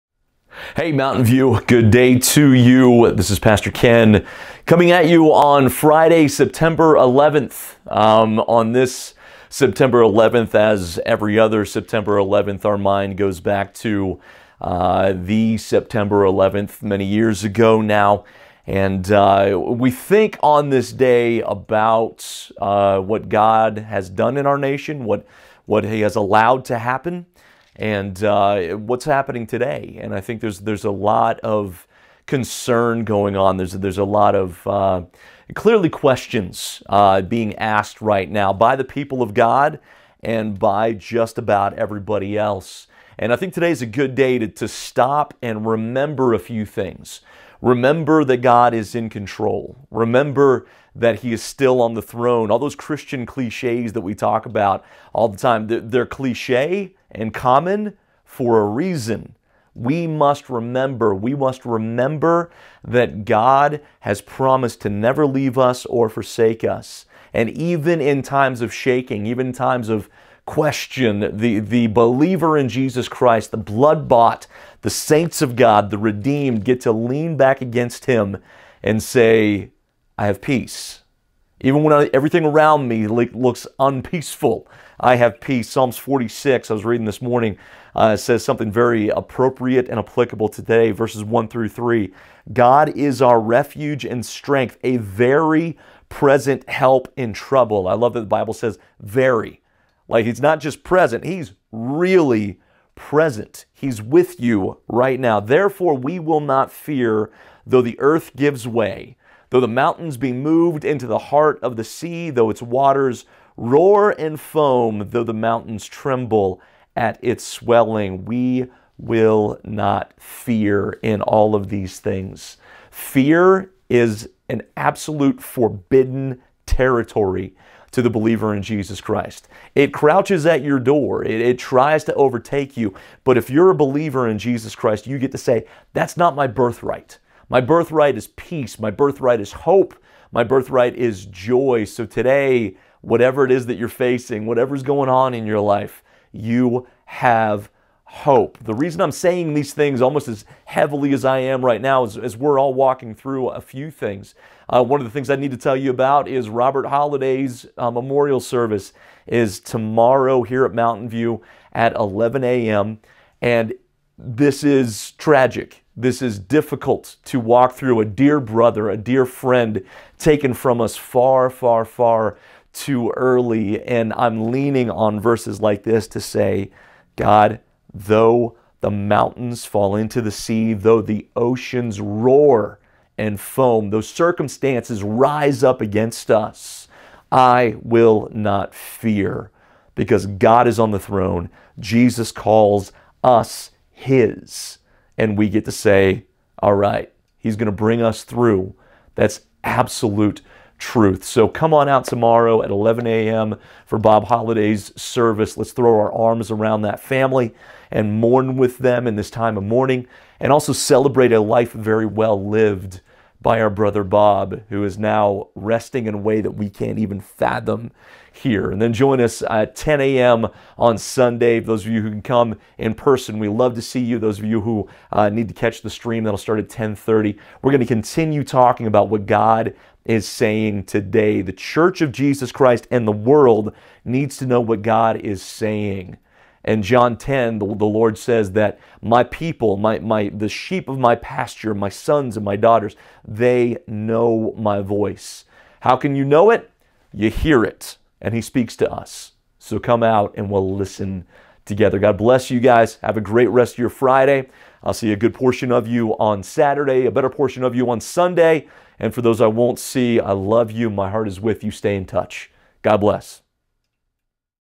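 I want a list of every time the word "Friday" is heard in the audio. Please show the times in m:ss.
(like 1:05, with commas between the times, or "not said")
0:05, 4:13.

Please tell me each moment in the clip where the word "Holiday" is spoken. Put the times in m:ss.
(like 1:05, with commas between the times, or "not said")
2:36, 3:24.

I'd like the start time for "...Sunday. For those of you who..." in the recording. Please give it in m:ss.
3:40.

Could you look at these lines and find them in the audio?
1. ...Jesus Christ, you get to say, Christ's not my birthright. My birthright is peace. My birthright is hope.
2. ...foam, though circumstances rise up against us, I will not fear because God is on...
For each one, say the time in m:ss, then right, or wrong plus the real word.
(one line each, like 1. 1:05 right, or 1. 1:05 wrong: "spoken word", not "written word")
1. 2:14 wrong: "That", not "Christ"
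2. 3:03 right.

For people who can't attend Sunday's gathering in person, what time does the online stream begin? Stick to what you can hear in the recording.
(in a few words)
10:30.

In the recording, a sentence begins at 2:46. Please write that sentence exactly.
This is difficult to walk through.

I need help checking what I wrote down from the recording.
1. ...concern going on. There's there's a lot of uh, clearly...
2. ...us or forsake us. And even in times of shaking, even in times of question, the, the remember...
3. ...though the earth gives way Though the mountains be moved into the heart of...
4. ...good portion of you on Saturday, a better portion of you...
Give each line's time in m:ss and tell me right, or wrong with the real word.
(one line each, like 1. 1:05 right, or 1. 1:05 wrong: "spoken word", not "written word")
1. 0:32 right
2. 1:05 wrong: "believer", not "remember"
3. 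1:47 right
4. 4:15 right.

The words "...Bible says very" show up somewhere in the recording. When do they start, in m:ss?
1:38.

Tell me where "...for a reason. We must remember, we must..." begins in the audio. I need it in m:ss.
0:58.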